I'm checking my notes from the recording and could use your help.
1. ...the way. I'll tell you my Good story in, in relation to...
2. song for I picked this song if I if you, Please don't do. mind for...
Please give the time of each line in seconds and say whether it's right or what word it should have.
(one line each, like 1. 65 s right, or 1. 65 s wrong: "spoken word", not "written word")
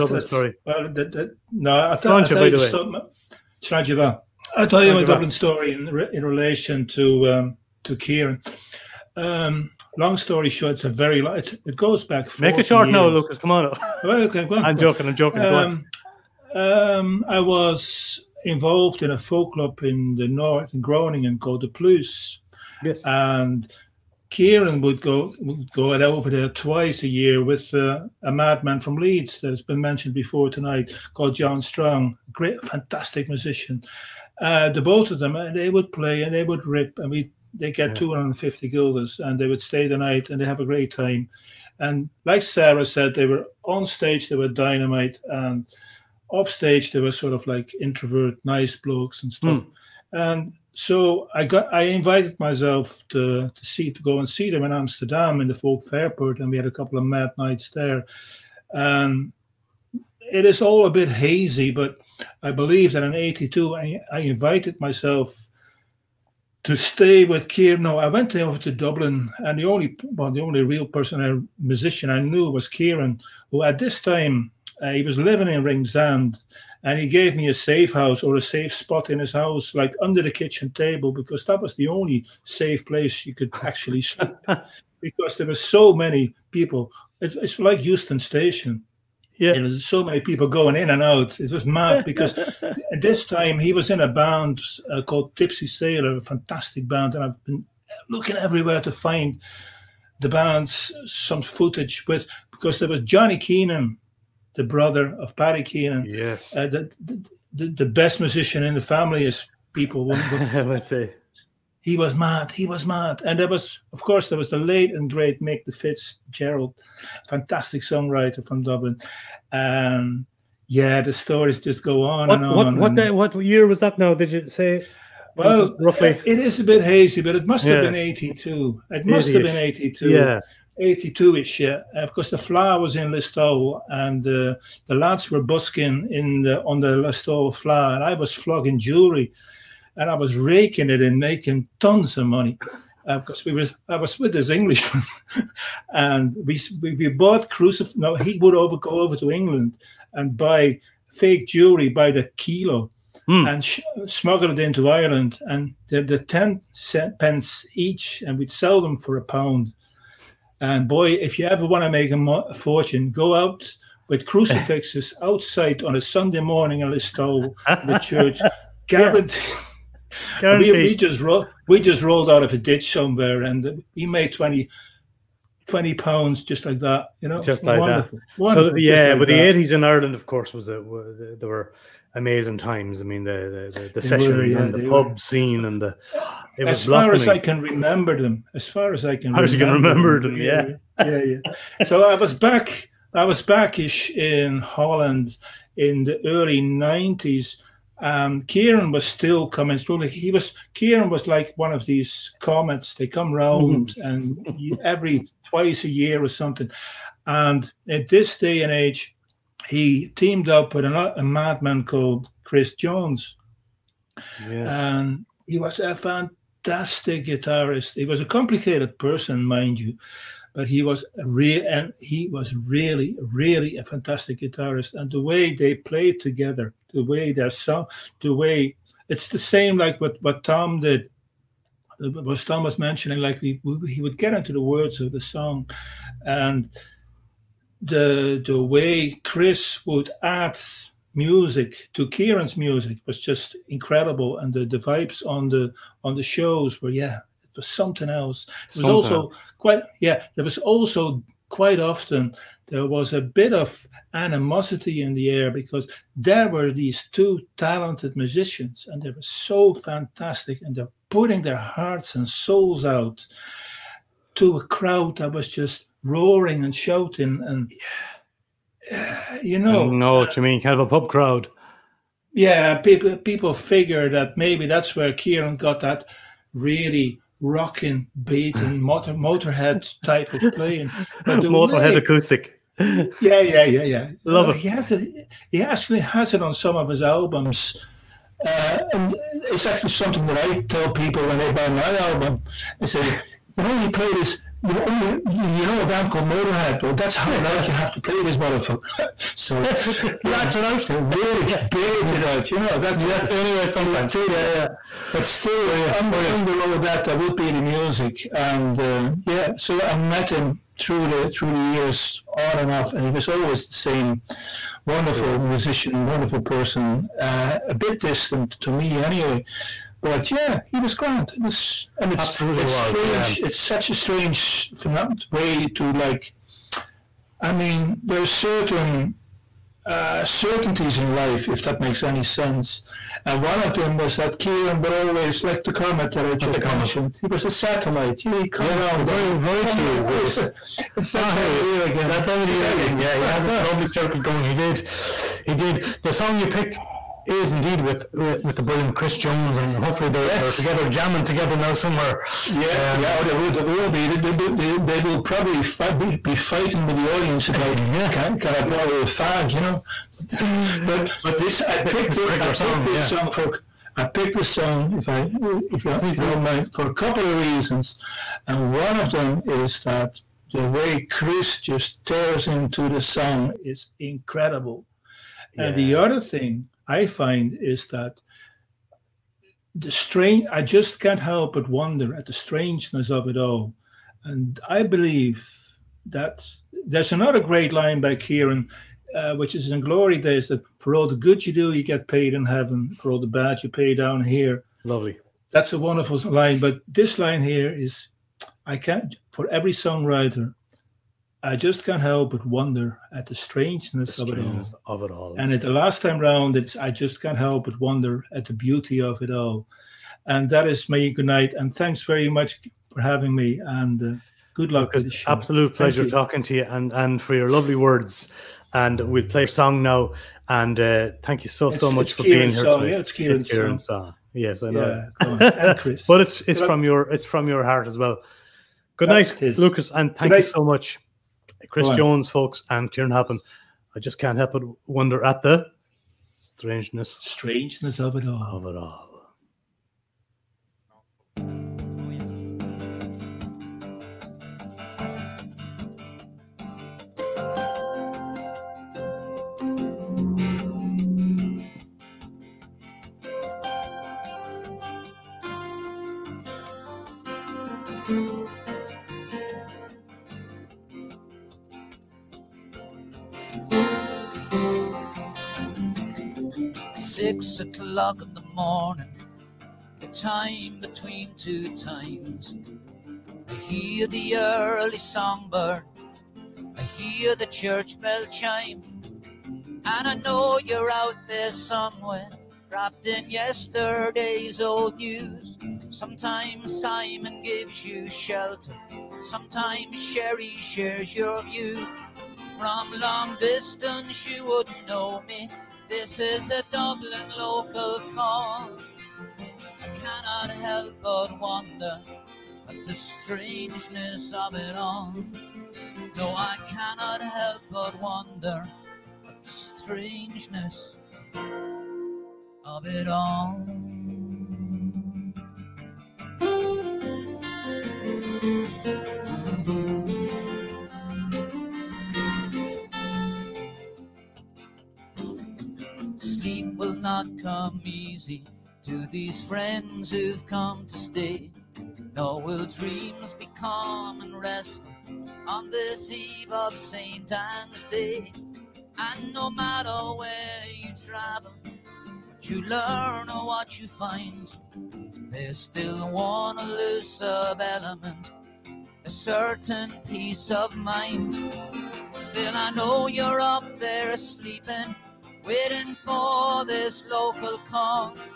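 1. 3 s wrong: "Dublin", not "Good"
2. 363 s right.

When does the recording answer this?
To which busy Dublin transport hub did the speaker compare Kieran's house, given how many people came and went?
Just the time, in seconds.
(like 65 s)
87 s.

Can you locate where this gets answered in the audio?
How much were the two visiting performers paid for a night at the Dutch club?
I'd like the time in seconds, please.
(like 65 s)
37 s.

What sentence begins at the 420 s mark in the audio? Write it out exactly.
And uh, thank you so it's, so much for Kieran's being here song.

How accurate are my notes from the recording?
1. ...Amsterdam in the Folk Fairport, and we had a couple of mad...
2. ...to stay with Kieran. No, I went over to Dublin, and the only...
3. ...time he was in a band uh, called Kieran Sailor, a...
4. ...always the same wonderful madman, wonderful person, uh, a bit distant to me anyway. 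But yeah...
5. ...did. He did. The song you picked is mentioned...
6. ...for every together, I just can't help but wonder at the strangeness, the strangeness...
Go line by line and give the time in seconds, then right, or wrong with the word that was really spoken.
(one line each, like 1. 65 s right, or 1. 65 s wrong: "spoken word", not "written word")
1. 54 s right
2. 66 s right
3. 93 s wrong: "Tipsy", not "Kieran"
4. 313 s wrong: "musician", not "madman"
5. 344 s wrong: "indeed", not "mentioned"
6. 399 s wrong: "songwriter", not "together".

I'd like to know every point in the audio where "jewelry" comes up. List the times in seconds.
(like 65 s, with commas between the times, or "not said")
138 s, 151 s.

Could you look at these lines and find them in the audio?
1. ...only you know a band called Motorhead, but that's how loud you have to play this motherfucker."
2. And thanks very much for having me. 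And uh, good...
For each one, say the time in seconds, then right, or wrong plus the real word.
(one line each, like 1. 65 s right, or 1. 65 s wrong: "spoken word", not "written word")
1. 294 s right
2. 411 s right.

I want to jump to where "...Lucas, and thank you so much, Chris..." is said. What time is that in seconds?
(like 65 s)
429 s.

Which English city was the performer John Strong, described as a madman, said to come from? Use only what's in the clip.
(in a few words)
Leeds.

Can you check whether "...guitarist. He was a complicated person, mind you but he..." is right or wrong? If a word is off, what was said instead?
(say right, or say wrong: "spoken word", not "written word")
right.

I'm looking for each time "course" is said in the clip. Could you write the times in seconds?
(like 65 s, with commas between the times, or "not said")
114 s, 180 s.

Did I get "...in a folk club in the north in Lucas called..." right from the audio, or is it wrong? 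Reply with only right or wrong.
wrong.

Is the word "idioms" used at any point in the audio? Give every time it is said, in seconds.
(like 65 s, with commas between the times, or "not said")
not said.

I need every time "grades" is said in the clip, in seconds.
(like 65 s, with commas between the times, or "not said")
not said.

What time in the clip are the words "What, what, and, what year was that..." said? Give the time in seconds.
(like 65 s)
122 s.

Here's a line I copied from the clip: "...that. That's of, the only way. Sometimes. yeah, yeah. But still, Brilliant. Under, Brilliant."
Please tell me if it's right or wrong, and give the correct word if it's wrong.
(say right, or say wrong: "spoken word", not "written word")
right.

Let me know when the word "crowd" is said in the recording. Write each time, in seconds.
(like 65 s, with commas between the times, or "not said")
264 s, 271 s.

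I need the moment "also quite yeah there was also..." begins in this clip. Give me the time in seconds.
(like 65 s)
249 s.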